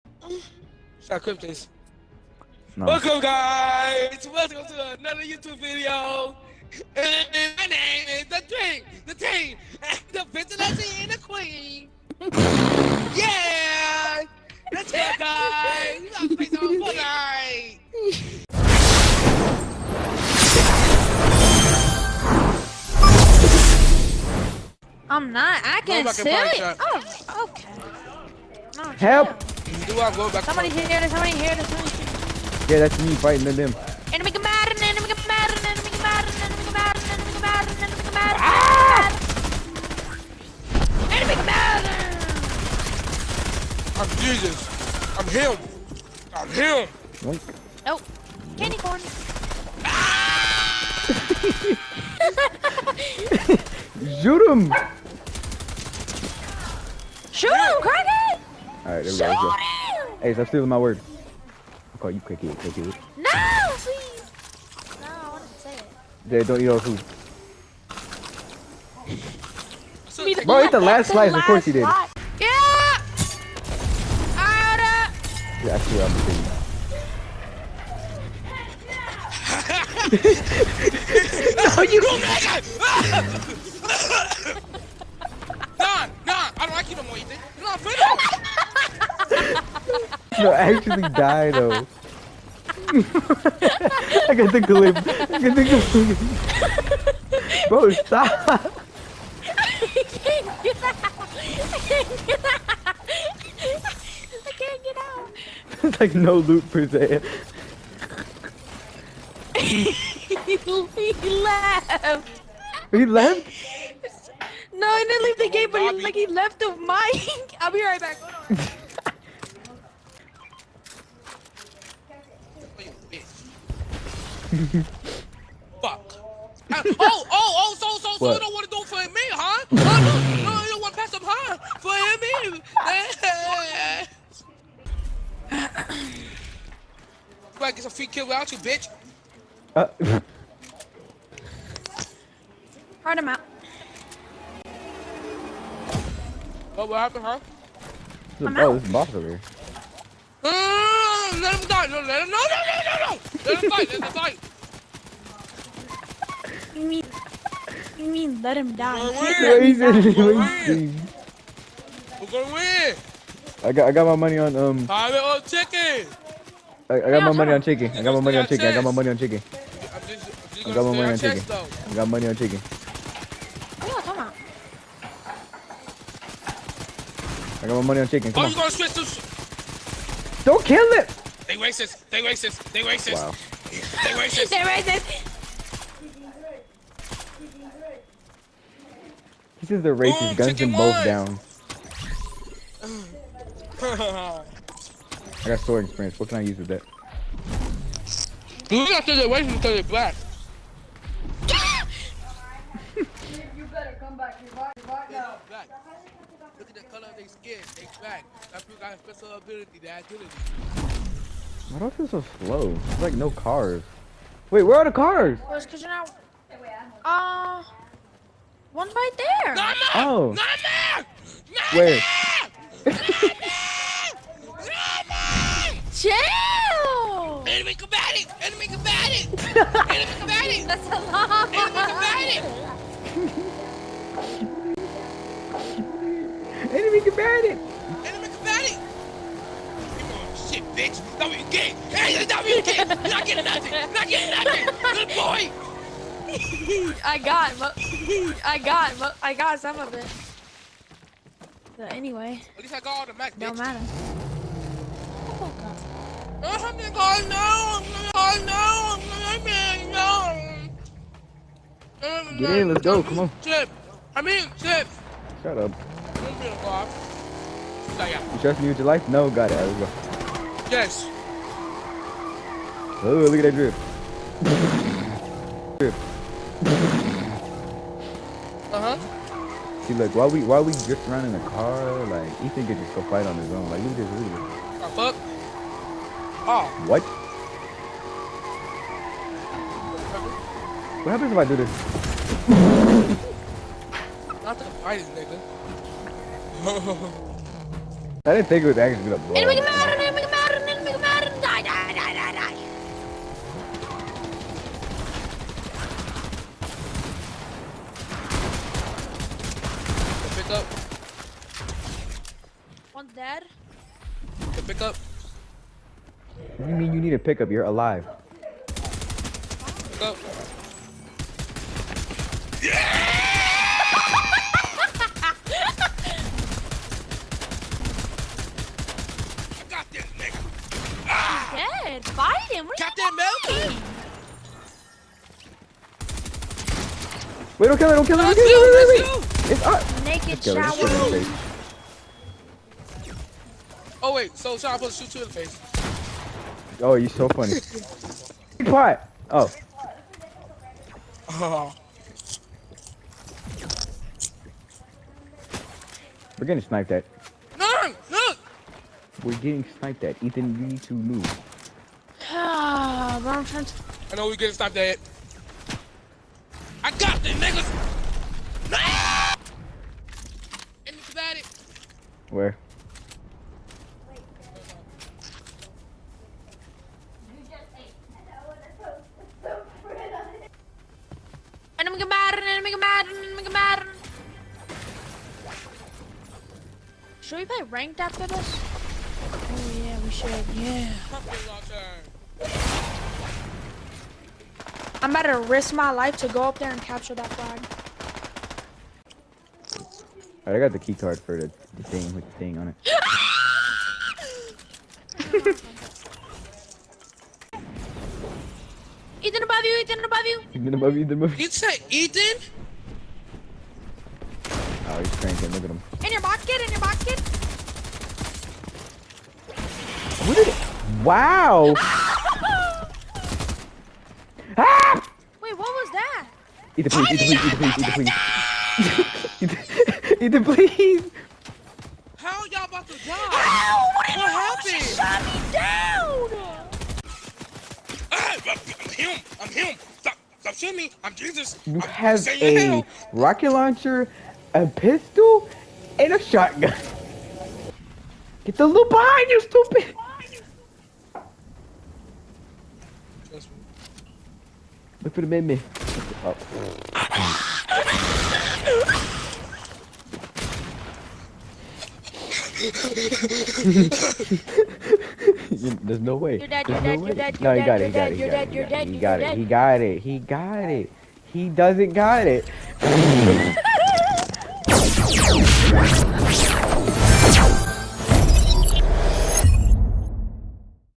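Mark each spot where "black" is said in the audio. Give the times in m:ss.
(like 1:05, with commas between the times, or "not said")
3:19, 3:27.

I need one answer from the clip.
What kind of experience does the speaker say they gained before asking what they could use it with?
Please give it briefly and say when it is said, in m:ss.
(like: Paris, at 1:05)
sword experience, at 3:15.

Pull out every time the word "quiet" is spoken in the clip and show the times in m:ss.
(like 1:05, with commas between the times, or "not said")
5:48.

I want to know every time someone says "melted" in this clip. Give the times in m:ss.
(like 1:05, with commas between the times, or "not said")
not said.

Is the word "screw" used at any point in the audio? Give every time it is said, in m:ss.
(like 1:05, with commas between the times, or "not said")
not said.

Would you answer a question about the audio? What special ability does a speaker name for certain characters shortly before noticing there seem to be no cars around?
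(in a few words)
agility.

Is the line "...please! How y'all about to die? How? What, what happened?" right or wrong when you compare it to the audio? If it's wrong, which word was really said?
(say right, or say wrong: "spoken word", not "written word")
right.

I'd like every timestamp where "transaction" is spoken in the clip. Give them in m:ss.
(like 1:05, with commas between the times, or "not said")
not said.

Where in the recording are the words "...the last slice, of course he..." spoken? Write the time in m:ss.
1:10.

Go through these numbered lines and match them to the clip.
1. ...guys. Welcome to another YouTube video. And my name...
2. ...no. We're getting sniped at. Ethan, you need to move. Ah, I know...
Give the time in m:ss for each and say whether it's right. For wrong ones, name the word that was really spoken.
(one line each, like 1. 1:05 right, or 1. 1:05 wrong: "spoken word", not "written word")
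1. 0:03 right
2. 5:58 right.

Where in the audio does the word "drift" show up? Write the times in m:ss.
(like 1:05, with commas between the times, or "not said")
4:40.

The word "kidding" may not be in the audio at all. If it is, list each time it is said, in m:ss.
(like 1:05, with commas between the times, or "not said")
1:20.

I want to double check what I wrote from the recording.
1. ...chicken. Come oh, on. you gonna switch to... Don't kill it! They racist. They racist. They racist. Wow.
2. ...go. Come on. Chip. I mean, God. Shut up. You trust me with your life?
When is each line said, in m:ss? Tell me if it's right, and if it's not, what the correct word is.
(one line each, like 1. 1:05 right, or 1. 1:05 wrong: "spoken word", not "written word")
1. 2:58 right
2. 4:22 wrong: "Chip", not "God".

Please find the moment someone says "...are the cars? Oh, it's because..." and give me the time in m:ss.
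3:34.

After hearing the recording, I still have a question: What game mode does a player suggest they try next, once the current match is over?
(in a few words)
ranked.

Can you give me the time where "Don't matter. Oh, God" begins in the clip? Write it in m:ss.
4:13.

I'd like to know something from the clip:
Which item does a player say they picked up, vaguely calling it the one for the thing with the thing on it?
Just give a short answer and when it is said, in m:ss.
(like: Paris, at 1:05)
key card, at 6:40.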